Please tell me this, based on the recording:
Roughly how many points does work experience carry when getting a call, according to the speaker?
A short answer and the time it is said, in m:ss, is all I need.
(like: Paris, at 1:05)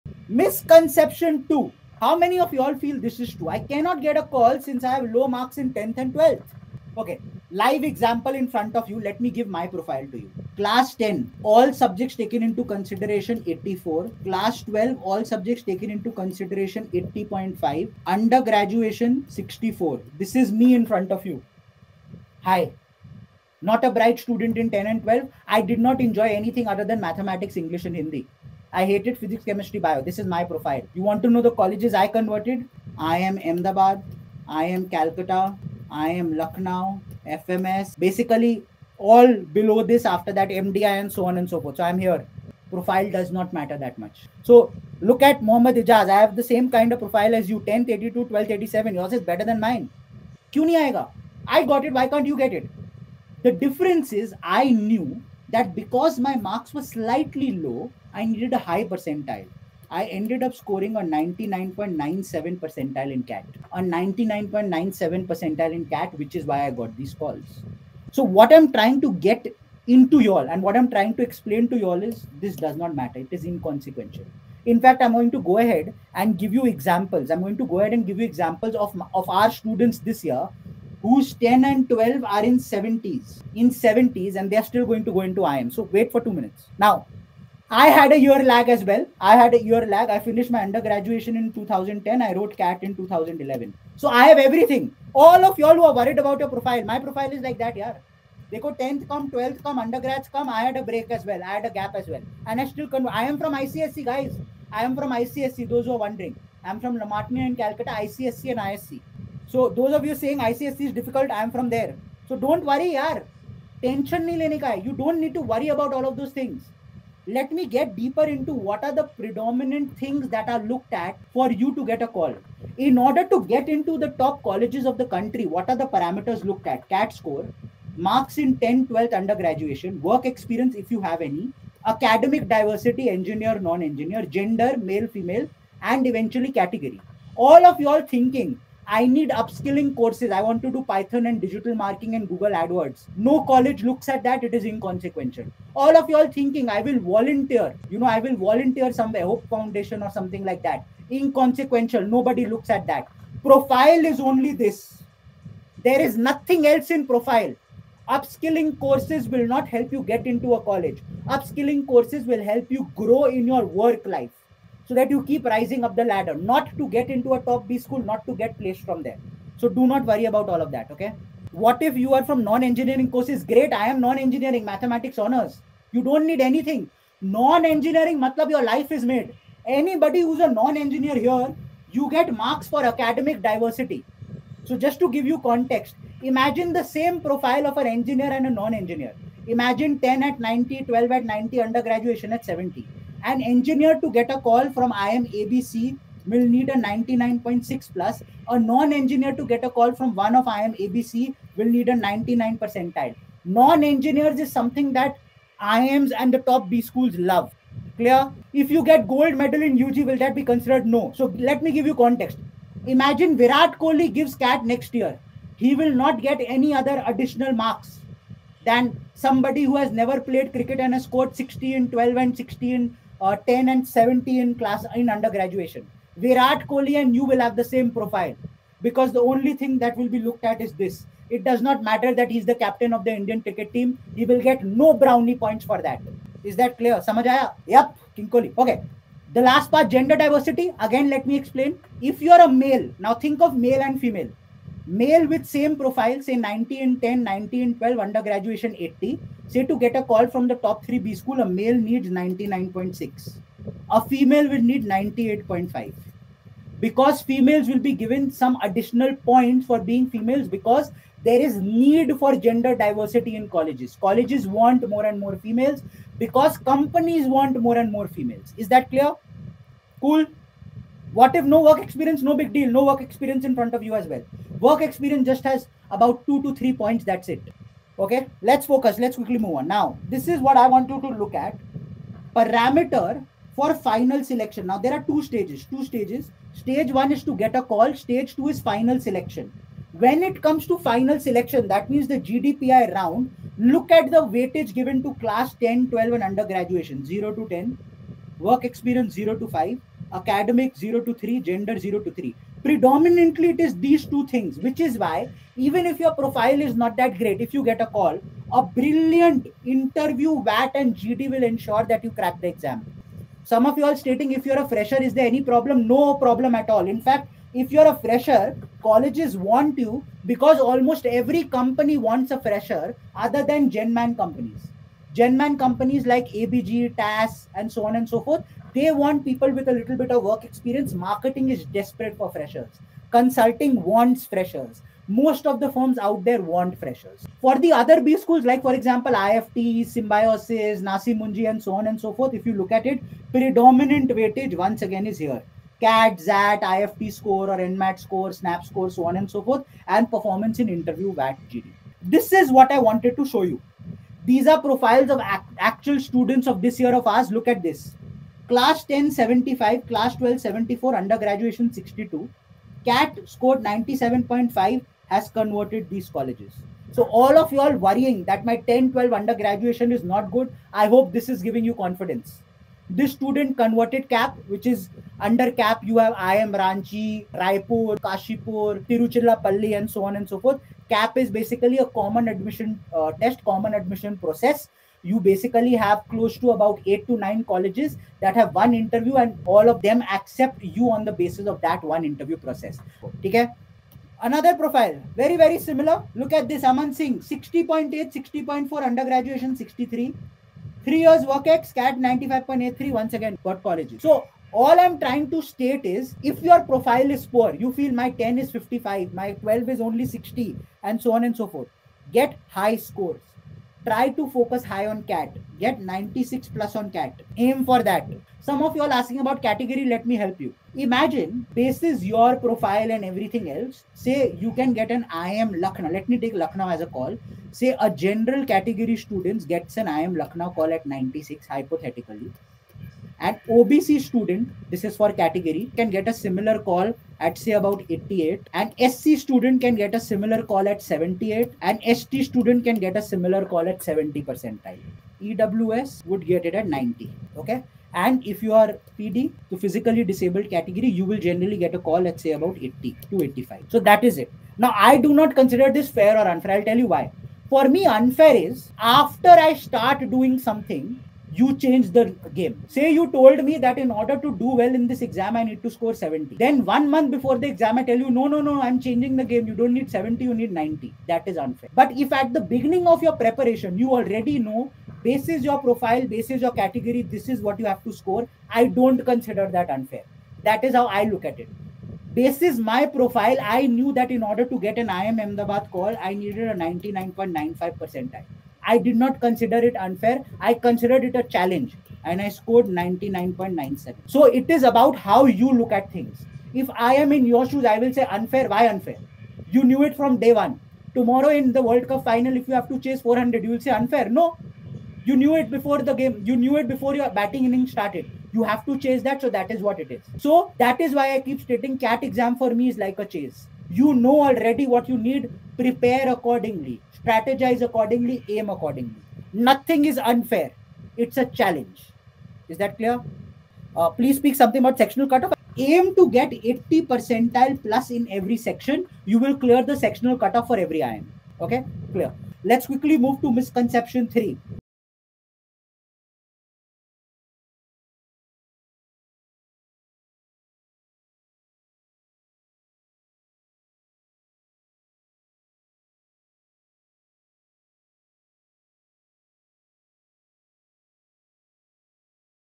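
2 to 3 points, at 4:36.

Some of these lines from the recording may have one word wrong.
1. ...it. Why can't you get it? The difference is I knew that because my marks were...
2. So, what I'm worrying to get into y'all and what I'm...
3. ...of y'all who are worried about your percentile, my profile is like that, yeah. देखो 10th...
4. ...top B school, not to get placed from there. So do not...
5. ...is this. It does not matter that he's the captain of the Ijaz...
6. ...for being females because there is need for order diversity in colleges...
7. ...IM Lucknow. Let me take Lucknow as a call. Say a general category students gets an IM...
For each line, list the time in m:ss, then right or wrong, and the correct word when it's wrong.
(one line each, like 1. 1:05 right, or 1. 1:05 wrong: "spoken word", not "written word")
1. 0:51 right
2. 1:08 wrong: "trying", not "worrying"
3. 1:35 wrong: "profile", not "percentile"
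4. 2:47 right
5. 3:50 wrong: "Indian", not "Ijaz"
6. 4:19 wrong: "gender", not "order"
7. 7:05 right.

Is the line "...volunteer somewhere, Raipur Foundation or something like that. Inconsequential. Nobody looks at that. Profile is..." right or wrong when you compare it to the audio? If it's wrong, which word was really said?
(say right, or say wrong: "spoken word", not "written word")
wrong: "Hope", not "Raipur".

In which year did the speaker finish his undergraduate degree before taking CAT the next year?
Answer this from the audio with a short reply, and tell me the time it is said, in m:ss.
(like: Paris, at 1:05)
2010, at 1:31.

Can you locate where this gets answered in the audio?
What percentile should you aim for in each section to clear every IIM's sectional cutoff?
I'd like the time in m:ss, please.
8:46.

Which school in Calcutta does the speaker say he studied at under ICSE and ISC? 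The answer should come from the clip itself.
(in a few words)
La Martiniere.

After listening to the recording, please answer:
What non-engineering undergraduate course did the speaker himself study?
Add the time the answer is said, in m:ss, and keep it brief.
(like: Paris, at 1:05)
Mathematics honors, at 2:54.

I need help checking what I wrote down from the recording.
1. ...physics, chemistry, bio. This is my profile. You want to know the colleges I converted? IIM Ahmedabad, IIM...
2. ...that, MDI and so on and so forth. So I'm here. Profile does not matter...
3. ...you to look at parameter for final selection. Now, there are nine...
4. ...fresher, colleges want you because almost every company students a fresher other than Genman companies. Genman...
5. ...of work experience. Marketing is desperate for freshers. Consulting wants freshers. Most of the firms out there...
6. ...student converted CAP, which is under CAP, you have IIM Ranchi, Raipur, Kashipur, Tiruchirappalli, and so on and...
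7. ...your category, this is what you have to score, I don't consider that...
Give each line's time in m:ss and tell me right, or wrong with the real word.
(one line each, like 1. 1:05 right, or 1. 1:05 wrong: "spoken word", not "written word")
1. 0:29 right
2. 0:40 right
3. 4:40 wrong: "two", not "nine"
4. 5:17 wrong: "wants", not "students"
5. 5:30 right
6. 6:13 right
7. 7:56 right.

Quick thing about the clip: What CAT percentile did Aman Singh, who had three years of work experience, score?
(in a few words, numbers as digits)
95.83.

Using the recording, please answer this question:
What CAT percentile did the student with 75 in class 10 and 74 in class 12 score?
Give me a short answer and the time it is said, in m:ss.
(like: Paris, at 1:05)
97.5, at 6:03.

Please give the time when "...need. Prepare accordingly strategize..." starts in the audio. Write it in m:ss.
8:34.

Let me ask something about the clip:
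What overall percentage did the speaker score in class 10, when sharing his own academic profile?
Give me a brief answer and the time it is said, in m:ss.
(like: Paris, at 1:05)
84, at 0:13.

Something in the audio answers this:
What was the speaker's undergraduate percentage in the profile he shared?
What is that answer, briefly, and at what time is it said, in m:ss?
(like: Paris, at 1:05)
64, at 0:19.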